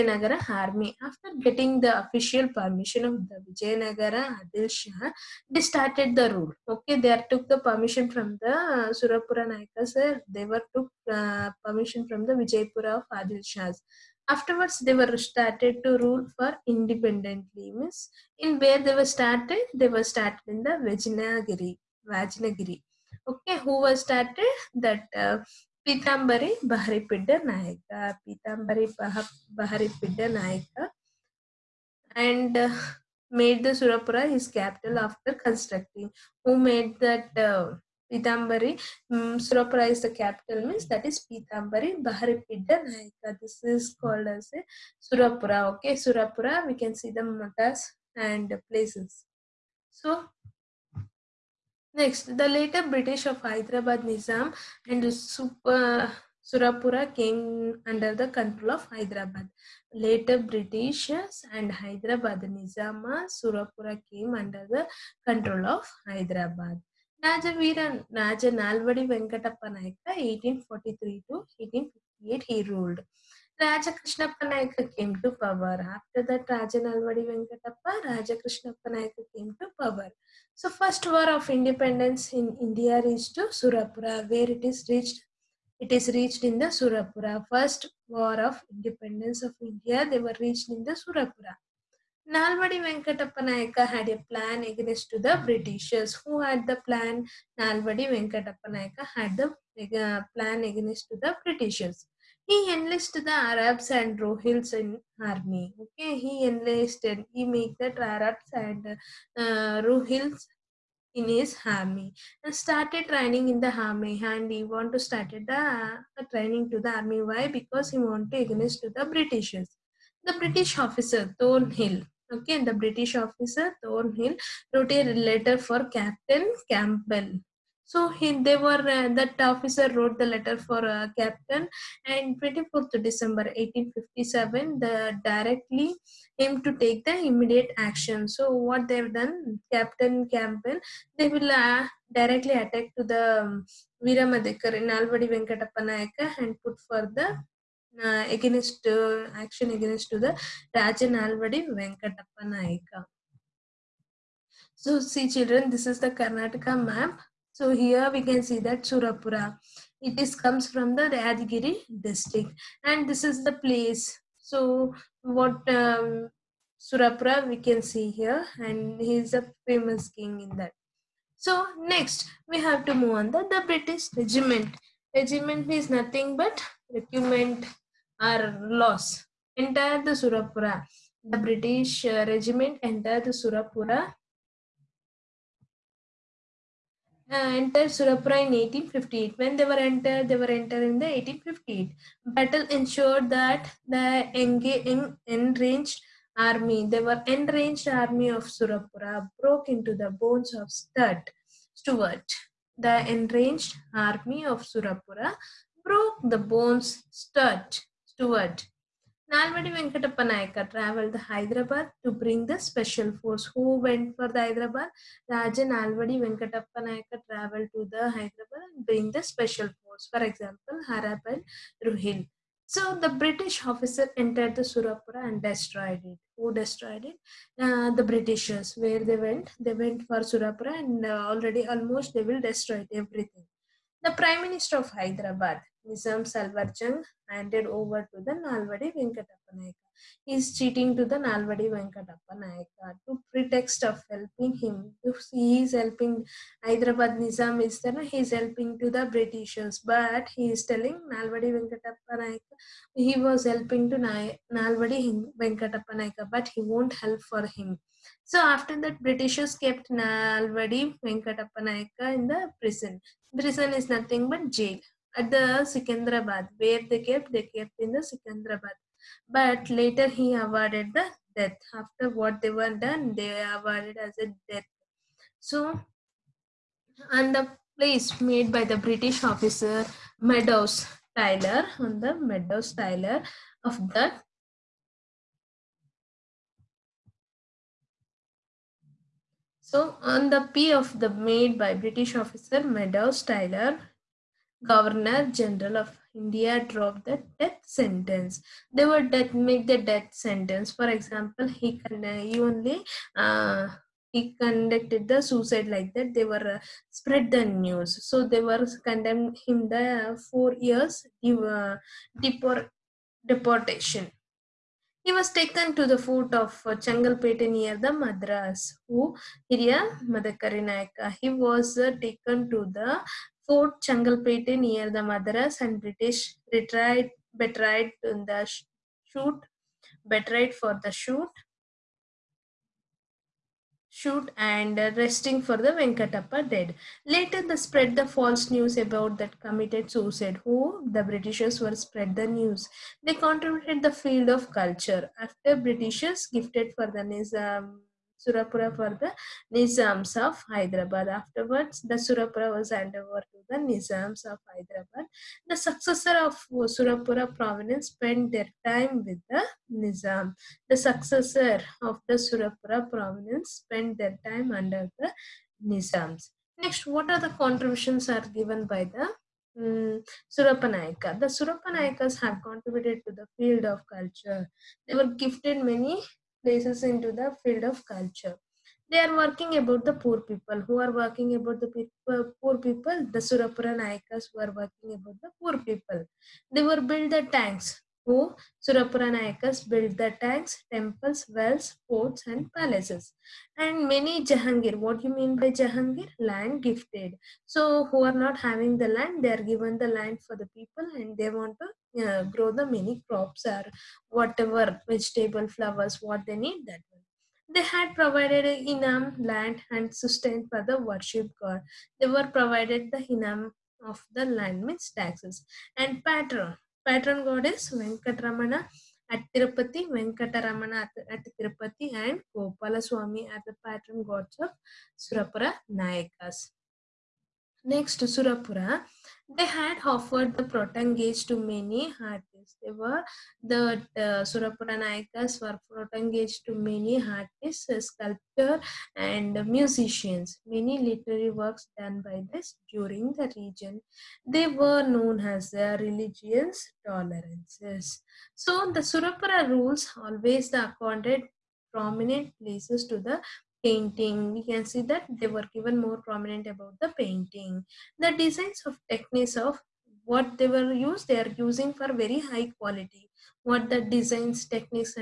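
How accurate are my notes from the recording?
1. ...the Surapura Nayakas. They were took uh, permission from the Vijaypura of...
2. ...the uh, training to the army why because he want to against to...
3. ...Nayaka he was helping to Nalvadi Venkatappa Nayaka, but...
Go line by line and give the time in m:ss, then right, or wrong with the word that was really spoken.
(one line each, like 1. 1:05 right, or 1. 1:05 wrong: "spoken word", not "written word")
1. 0:08 right
2. 1:55 right
3. 4:12 right.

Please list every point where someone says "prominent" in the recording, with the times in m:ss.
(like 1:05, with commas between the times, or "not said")
7:31, 7:36.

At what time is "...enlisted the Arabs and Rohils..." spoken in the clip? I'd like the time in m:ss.
1:42.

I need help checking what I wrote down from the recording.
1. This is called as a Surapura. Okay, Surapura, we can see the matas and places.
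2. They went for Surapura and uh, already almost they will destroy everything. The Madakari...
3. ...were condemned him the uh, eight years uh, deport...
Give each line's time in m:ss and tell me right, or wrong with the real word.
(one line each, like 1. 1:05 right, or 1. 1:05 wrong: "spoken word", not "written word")
1. 0:43 right
2. 3:49 wrong: "Prime", not "Madakari"
3. 5:08 wrong: "four", not "eight".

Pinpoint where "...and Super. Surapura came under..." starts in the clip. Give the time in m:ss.
0:54.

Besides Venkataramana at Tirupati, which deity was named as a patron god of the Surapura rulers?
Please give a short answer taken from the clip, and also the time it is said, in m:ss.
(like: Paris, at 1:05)
Gopala Swami, at 7:02.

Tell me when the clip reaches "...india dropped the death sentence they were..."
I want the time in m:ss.
4:56.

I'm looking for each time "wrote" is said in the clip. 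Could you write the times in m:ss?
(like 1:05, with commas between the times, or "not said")
2:04, 2:09.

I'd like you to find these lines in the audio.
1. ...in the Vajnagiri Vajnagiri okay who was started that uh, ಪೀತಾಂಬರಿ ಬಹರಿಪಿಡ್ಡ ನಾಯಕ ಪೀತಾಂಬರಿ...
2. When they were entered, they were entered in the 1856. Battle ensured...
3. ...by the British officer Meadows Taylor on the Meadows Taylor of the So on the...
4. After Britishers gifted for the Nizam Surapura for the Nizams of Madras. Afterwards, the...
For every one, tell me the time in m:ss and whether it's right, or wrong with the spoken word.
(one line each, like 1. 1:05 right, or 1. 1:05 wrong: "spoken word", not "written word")
1. 0:20 right
2. 3:09 wrong: "1858", not "1856"
3. 4:38 right
4. 5:45 wrong: "Hyderabad", not "Madras".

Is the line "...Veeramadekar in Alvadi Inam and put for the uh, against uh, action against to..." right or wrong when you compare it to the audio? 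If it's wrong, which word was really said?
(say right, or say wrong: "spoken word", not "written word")
wrong: "Venkatappa", not "Inam".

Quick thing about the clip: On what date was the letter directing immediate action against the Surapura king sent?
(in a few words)
24th December 1857.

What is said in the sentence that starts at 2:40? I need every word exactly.
It is comes from the Rajgiri district and this is the place.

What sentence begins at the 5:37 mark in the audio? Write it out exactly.
Later they spread the false news about that committed suicide.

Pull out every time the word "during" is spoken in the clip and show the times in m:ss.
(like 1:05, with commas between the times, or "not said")
7:22.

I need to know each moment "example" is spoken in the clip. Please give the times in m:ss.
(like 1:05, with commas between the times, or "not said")
3:40, 5:00.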